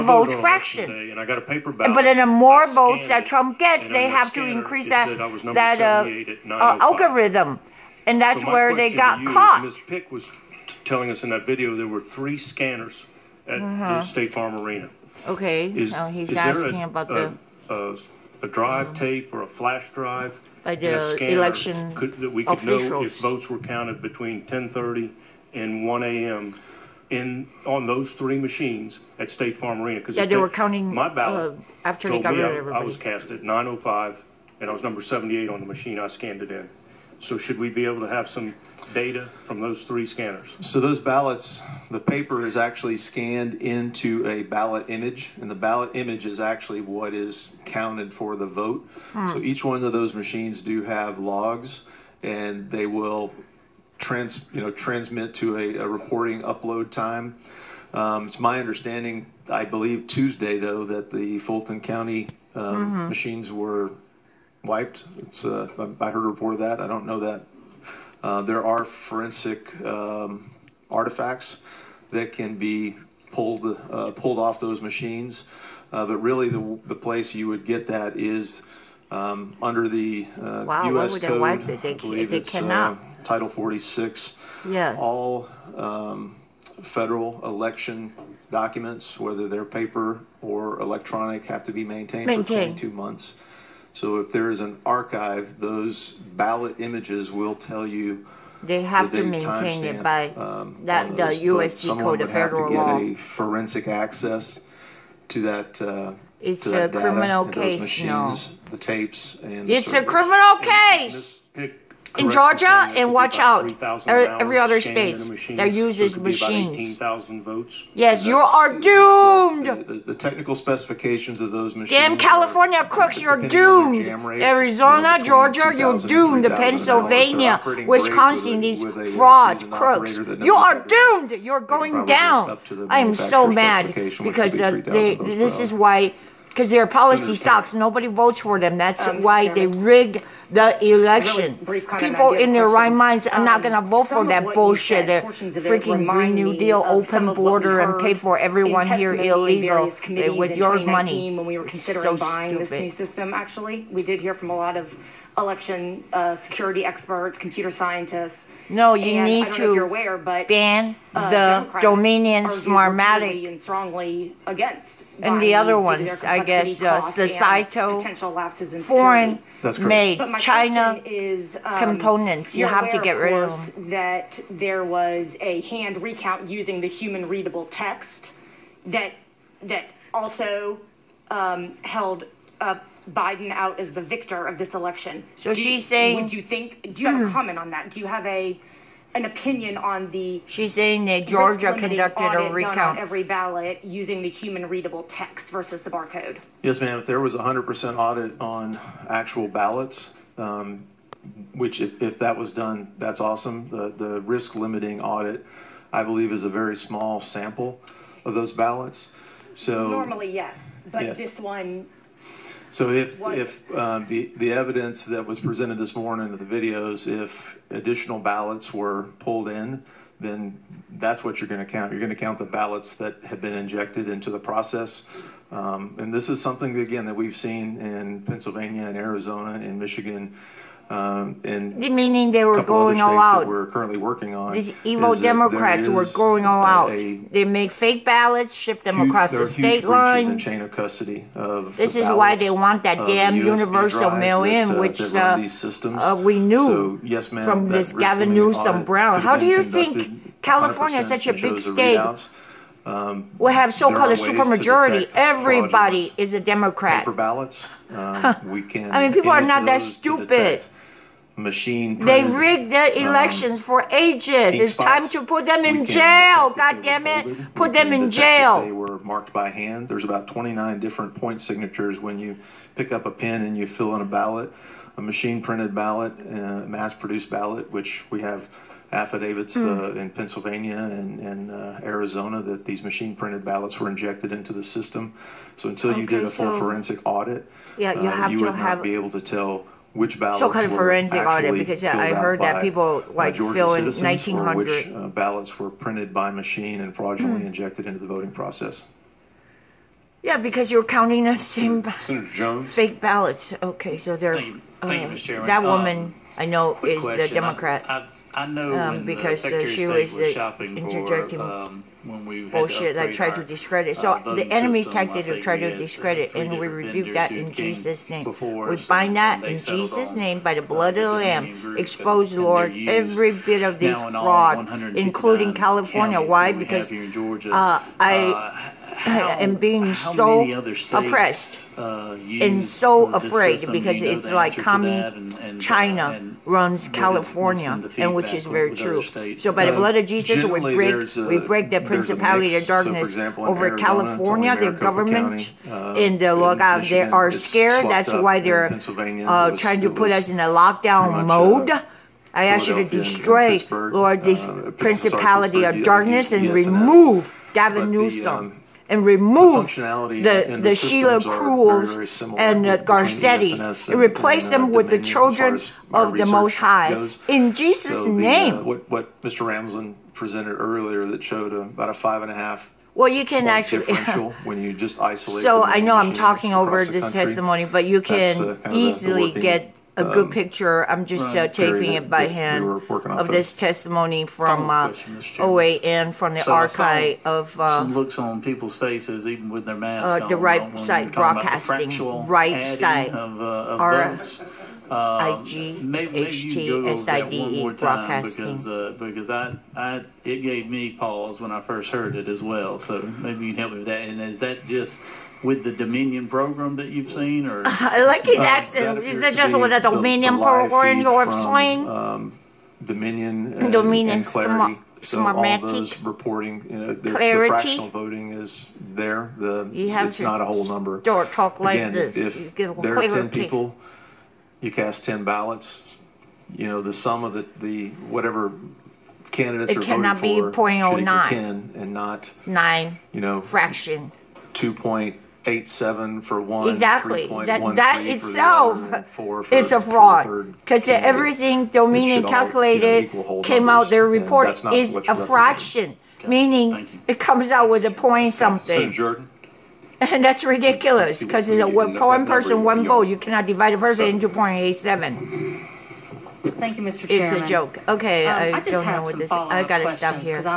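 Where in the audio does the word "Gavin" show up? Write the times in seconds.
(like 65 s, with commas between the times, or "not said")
247 s, 357 s.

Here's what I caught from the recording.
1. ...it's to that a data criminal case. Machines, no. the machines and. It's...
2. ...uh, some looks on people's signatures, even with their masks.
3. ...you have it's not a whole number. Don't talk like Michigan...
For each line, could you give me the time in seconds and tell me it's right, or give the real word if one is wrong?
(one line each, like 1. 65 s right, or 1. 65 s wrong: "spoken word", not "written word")
1. 106 s wrong: "tapes", not "machines"
2. 387 s wrong: "faces", not "signatures"
3. 419 s wrong: "Again", not "Michigan".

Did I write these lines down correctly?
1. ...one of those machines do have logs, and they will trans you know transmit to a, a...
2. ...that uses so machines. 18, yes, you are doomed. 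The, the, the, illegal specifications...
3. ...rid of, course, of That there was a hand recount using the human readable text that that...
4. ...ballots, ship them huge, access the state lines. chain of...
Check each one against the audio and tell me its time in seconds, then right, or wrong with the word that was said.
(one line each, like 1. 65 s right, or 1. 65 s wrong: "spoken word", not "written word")
1. 49 s right
2. 115 s wrong: "technical", not "illegal"
3. 173 s right
4. 238 s wrong: "across", not "access".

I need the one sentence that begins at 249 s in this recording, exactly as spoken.
How do you think California is such a big state?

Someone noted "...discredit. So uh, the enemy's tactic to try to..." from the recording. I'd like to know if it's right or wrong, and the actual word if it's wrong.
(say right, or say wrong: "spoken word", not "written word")
right.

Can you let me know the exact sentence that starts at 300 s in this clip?
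Yeah, because you're counting the same Jones fake ballots.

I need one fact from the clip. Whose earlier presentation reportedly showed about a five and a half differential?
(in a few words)
Mr. Ramsland.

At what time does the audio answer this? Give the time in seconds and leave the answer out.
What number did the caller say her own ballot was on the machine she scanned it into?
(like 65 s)
34 s.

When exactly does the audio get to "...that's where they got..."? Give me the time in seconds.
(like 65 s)
8 s.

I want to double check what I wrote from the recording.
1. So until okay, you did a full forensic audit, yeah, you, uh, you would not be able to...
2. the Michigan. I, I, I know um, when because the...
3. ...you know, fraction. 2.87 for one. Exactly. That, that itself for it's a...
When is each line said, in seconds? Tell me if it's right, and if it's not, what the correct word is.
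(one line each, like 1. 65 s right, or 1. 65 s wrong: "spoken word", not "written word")
1. 285 s right
2. 307 s wrong: "Democrat", not "Michigan"
3. 433 s right.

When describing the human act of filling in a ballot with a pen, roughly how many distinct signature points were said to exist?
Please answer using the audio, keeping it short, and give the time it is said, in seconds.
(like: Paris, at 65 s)
29, at 270 s.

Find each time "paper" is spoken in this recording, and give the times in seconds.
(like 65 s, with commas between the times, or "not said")
41 s, 89 s, 257 s.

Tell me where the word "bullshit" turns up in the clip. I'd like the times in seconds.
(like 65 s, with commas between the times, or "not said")
144 s, 312 s.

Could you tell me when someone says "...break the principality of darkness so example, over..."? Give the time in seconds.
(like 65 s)
341 s.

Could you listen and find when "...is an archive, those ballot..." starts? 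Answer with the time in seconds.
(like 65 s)
94 s.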